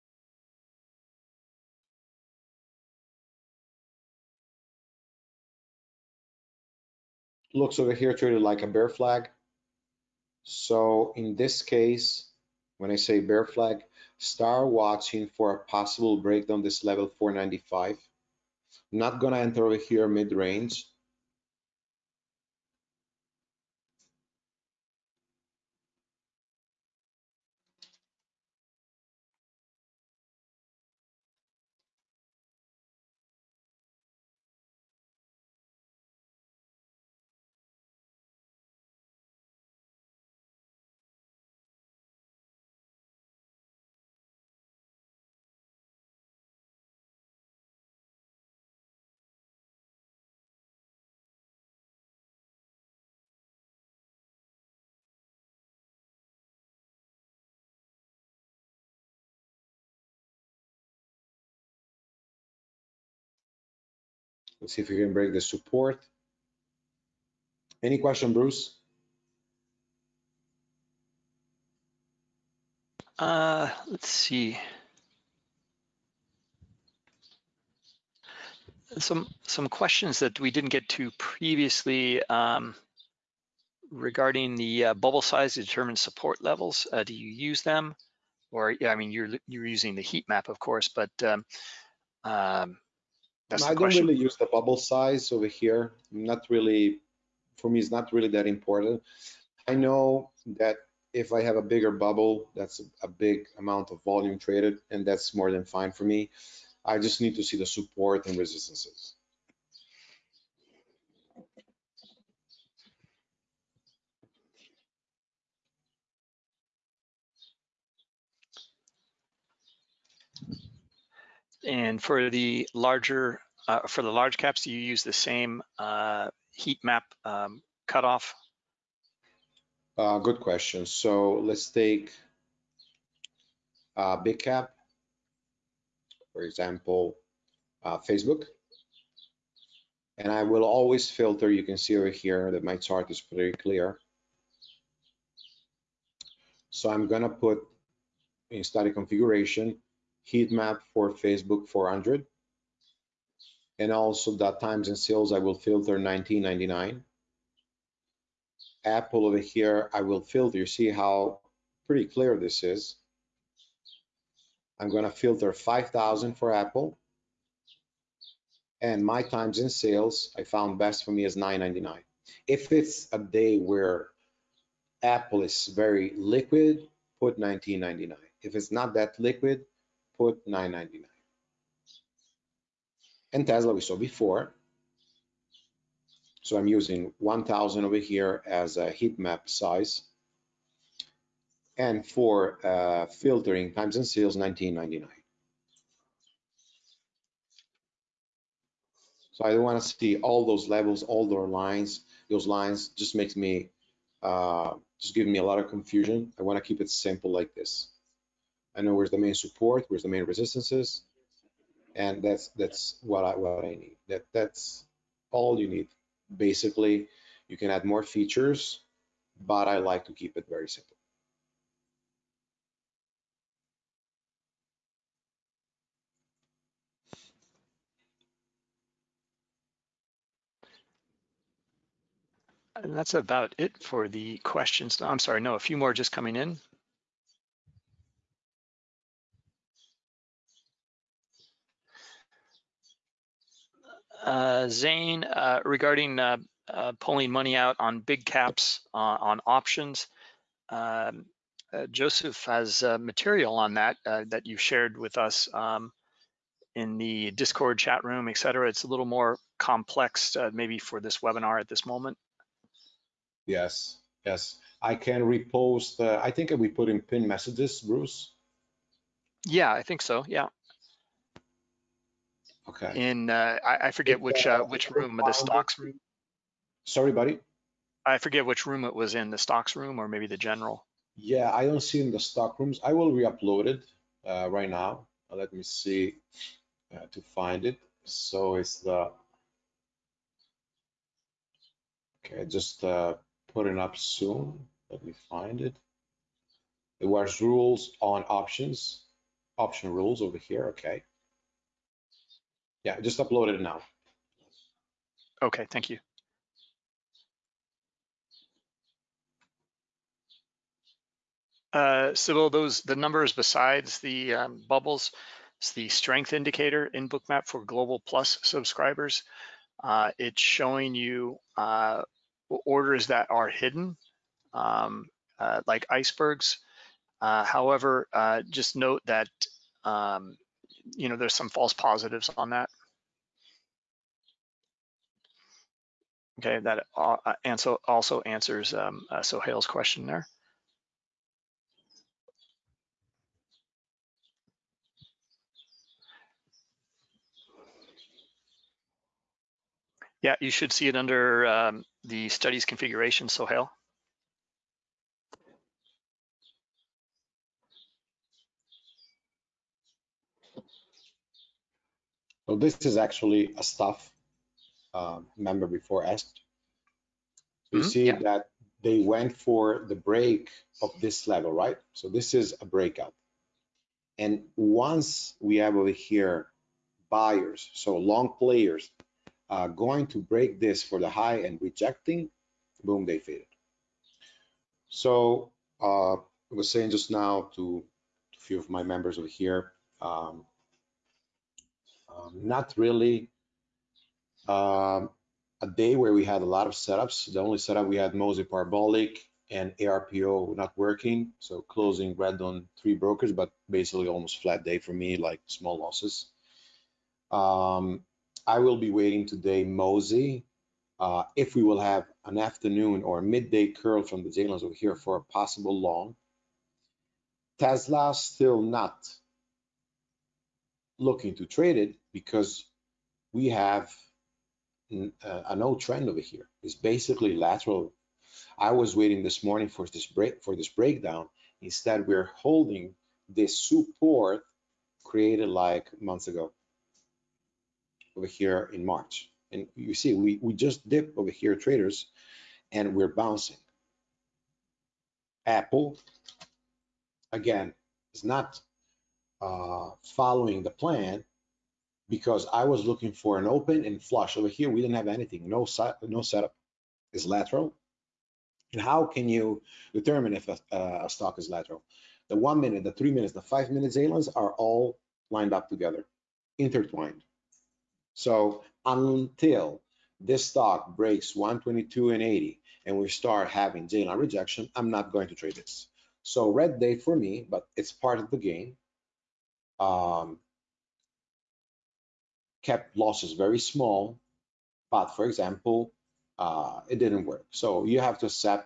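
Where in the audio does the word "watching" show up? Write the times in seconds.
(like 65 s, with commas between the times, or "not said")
14 s.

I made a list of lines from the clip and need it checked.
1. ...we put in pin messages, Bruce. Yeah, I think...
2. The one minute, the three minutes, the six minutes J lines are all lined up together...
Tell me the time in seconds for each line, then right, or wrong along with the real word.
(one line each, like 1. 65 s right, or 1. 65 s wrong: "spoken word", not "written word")
1. 266 s right
2. 462 s wrong: "five", not "six".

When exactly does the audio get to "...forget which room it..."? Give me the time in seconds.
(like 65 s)
278 s.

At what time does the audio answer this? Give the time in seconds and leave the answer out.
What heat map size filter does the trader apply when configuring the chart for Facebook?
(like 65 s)
151 s.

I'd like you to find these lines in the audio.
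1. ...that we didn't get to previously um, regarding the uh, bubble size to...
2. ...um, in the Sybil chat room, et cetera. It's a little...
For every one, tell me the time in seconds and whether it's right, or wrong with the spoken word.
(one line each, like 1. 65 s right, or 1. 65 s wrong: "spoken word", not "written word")
1. 80 s right
2. 255 s wrong: "Discord", not "Sybil".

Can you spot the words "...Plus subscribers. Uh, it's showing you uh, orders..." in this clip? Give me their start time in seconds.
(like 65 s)
318 s.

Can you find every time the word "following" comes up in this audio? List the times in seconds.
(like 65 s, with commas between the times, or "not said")
450 s.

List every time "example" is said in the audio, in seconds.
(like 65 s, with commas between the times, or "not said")
136 s, 485 s.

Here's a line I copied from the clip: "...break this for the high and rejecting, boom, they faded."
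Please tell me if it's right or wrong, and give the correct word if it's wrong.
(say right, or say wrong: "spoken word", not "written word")
right.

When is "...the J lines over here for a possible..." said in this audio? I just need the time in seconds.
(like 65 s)
414 s.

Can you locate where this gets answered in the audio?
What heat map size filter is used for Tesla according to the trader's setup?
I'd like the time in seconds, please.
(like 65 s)
187 s.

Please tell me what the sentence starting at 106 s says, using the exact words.
I just need to see the support and resistances.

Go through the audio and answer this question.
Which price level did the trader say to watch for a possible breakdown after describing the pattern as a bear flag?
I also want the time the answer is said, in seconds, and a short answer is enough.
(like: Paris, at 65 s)
495, at 17 s.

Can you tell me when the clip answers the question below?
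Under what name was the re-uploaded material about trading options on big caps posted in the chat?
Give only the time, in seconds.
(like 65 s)
299 s.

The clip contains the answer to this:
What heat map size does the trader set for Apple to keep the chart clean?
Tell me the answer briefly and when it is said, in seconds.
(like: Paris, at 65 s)
5,000, at 165 s.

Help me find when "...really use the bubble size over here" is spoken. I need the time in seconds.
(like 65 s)
93 s.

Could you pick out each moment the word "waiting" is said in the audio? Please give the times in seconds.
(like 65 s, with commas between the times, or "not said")
408 s, 428 s.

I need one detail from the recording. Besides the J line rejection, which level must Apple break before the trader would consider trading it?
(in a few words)
122.80.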